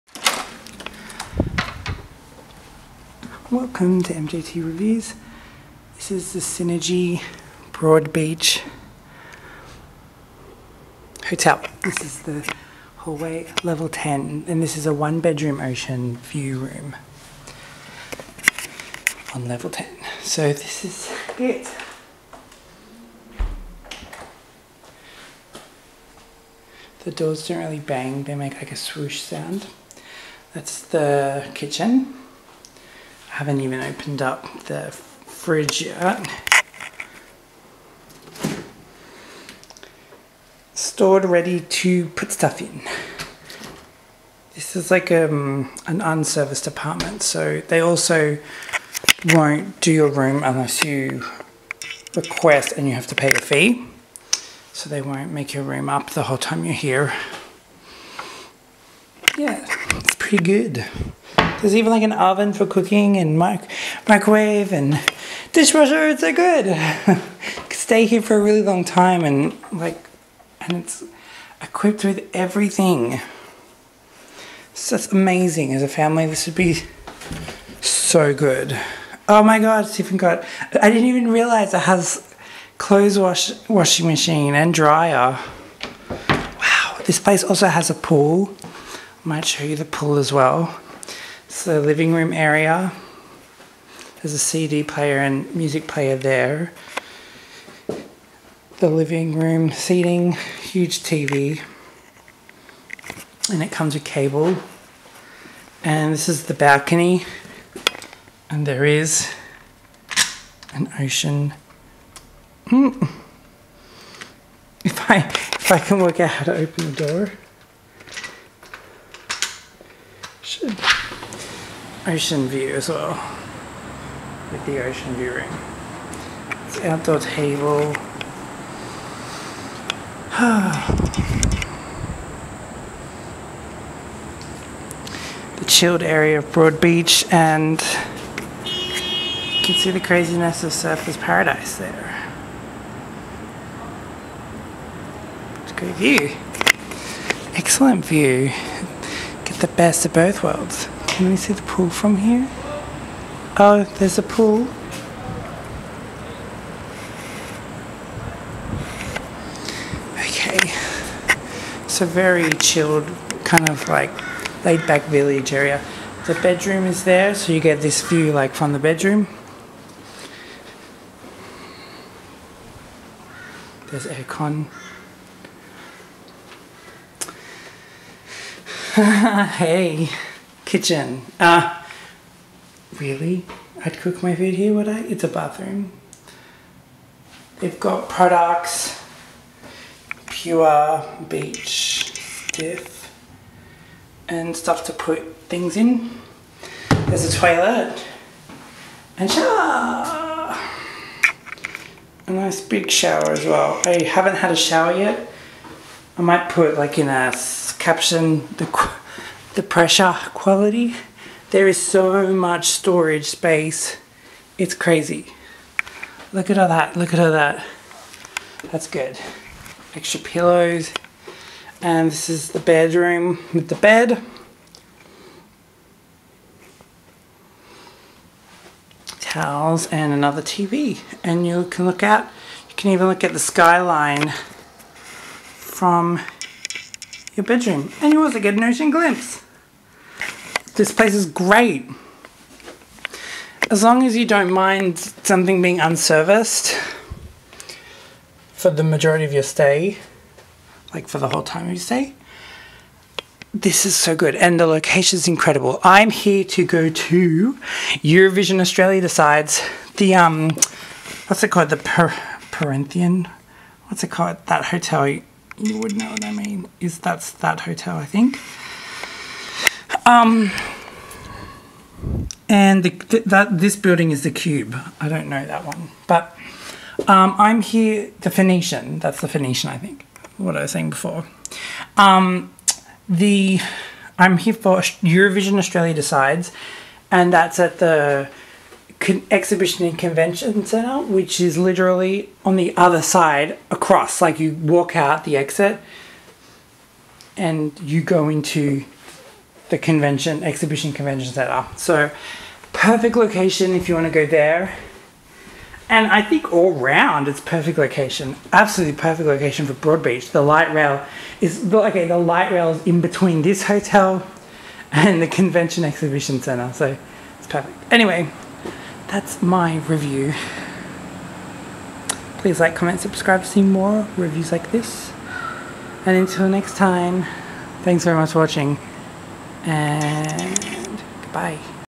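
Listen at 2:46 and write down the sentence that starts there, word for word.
The bedroom is there, so you get this view like from the bedroom.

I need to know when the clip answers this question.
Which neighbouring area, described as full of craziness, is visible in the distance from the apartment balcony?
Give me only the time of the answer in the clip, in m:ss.
2:20.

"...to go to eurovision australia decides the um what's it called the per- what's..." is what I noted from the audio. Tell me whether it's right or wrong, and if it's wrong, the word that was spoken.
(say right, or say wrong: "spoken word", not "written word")
right.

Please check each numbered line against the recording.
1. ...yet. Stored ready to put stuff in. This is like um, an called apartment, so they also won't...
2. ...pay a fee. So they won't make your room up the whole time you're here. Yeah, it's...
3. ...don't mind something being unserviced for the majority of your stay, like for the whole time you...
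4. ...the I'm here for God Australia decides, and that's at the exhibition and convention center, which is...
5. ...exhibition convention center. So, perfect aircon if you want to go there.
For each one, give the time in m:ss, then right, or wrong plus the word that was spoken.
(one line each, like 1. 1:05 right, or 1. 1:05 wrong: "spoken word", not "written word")
1. 0:35 wrong: "unserviced", not "called"
2. 0:53 right
3. 4:04 right
4. 4:43 wrong: "Eurovision", not "God"
5. 5:00 wrong: "location", not "aircon".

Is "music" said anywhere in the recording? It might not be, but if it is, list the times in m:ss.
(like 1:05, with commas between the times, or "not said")
1:35.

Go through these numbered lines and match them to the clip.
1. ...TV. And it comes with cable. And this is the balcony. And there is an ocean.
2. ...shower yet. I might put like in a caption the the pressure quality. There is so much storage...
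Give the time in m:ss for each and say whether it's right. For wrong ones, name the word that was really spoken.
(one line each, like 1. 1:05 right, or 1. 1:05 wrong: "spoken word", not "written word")
1. 1:41 right
2. 3:24 right.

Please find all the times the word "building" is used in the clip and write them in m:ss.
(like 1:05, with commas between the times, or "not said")
4:33.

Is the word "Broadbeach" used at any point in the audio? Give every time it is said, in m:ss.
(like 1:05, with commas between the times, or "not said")
0:07, 2:16, 5:09.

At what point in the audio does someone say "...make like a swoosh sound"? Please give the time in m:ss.
0:28.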